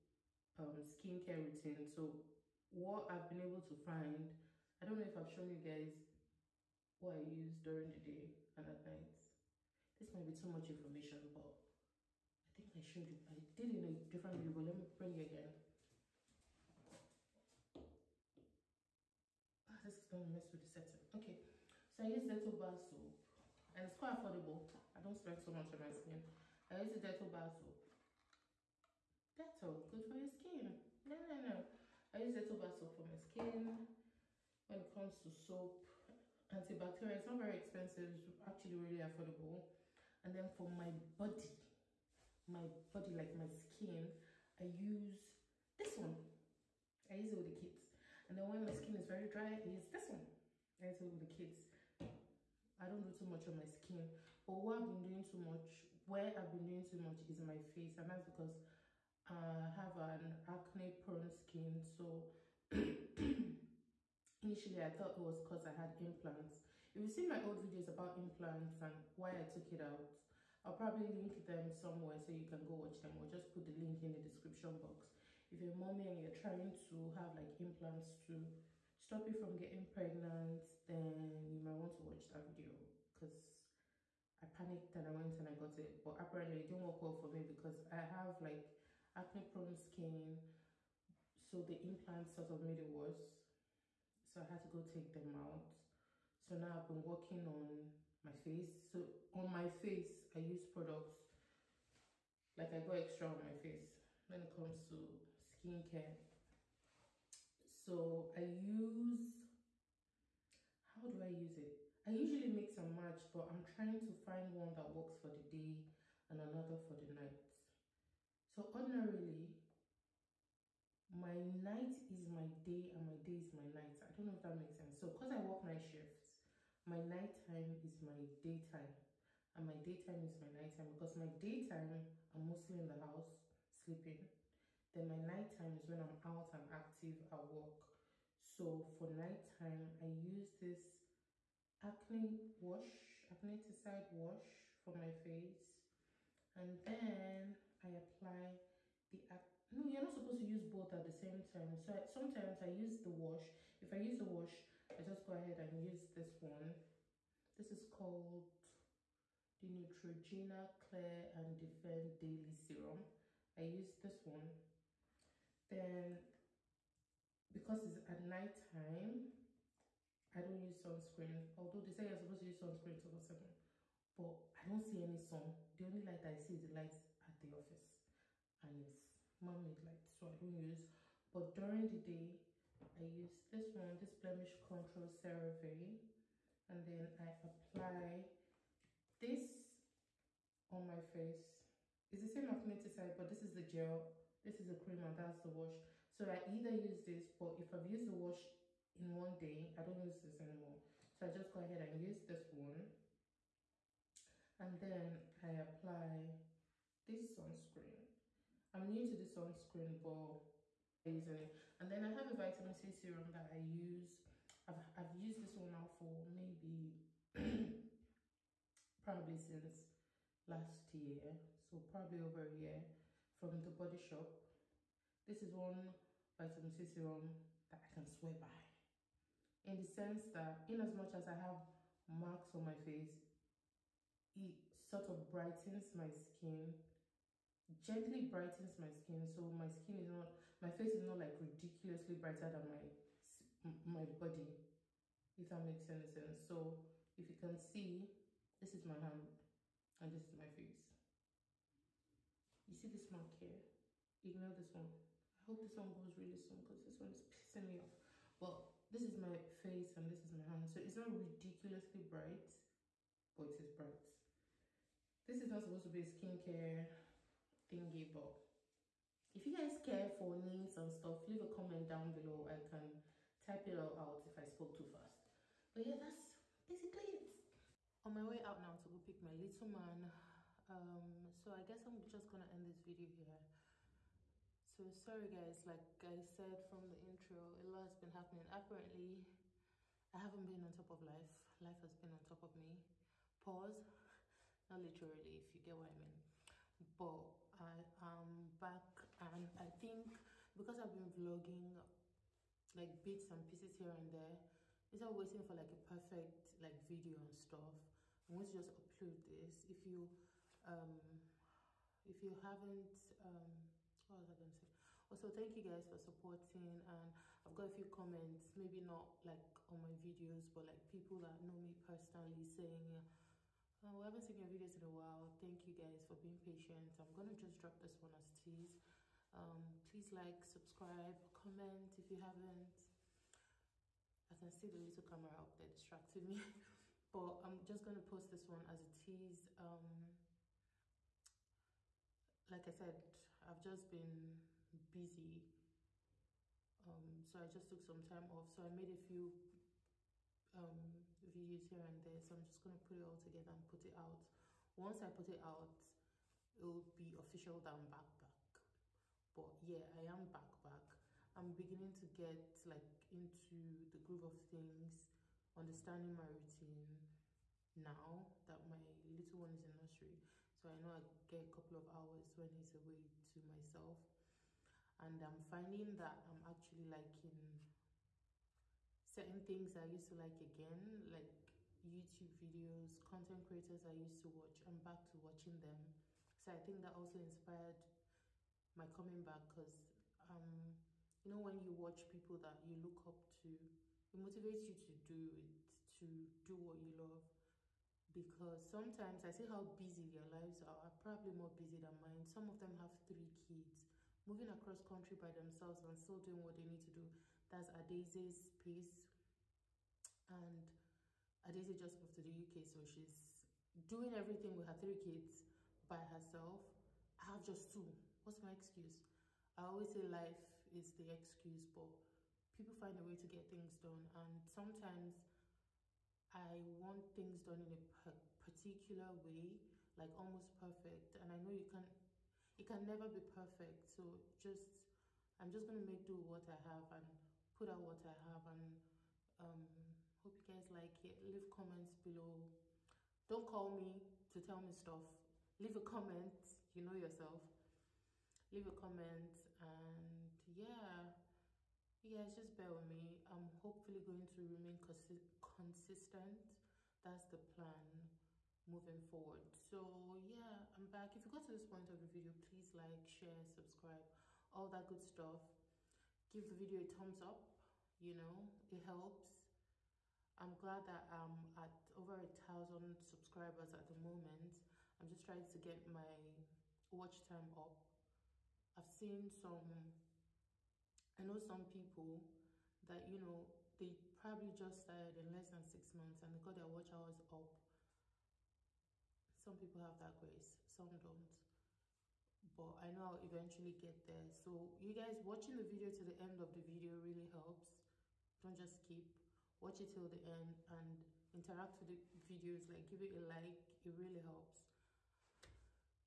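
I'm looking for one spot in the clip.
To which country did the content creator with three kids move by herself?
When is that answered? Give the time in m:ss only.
6:52.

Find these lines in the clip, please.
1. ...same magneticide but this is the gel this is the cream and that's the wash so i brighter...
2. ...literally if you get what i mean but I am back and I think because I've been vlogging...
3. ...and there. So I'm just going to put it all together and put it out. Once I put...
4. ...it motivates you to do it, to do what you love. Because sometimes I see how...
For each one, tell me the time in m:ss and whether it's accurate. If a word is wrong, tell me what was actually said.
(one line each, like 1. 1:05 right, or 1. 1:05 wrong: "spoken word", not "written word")
1. 3:12 wrong: "either", not "brighter"
2. 4:54 right
3. 5:51 right
4. 6:34 right.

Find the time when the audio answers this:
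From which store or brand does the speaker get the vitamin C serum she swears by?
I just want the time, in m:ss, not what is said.
3:43.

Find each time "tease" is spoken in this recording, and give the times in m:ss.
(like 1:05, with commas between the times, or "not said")
5:28, 5:38.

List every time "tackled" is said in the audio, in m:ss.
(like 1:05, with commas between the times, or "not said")
not said.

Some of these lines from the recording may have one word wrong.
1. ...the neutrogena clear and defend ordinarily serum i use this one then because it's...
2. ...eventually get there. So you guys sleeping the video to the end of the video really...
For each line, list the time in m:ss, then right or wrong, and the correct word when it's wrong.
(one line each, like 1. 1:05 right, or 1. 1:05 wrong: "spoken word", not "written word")
1. 2:39 wrong: "daily", not "ordinarily"
2. 8:13 wrong: "watching", not "sleeping".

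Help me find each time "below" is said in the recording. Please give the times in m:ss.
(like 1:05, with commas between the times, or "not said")
4:32, 7:21.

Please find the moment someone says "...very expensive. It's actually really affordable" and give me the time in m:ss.
0:37.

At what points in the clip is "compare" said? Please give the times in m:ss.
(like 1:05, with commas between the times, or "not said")
not said.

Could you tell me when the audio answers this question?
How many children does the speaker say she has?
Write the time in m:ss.
6:57.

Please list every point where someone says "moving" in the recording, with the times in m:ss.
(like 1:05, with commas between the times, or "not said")
6:44, 7:38.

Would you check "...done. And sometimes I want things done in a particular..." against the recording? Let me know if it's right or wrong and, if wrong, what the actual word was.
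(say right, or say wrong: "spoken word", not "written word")
right.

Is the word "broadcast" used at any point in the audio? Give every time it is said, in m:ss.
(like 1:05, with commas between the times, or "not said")
not said.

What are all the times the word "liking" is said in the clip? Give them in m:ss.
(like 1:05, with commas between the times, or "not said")
6:16.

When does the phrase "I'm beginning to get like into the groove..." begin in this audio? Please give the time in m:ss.
6:01.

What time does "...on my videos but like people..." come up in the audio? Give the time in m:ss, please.
5:19.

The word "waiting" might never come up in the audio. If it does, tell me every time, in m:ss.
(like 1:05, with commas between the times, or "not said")
5:05.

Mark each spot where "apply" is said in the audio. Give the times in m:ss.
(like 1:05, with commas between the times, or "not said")
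2:27, 3:07, 3:25.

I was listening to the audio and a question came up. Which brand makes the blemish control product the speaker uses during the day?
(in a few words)
CeraVe.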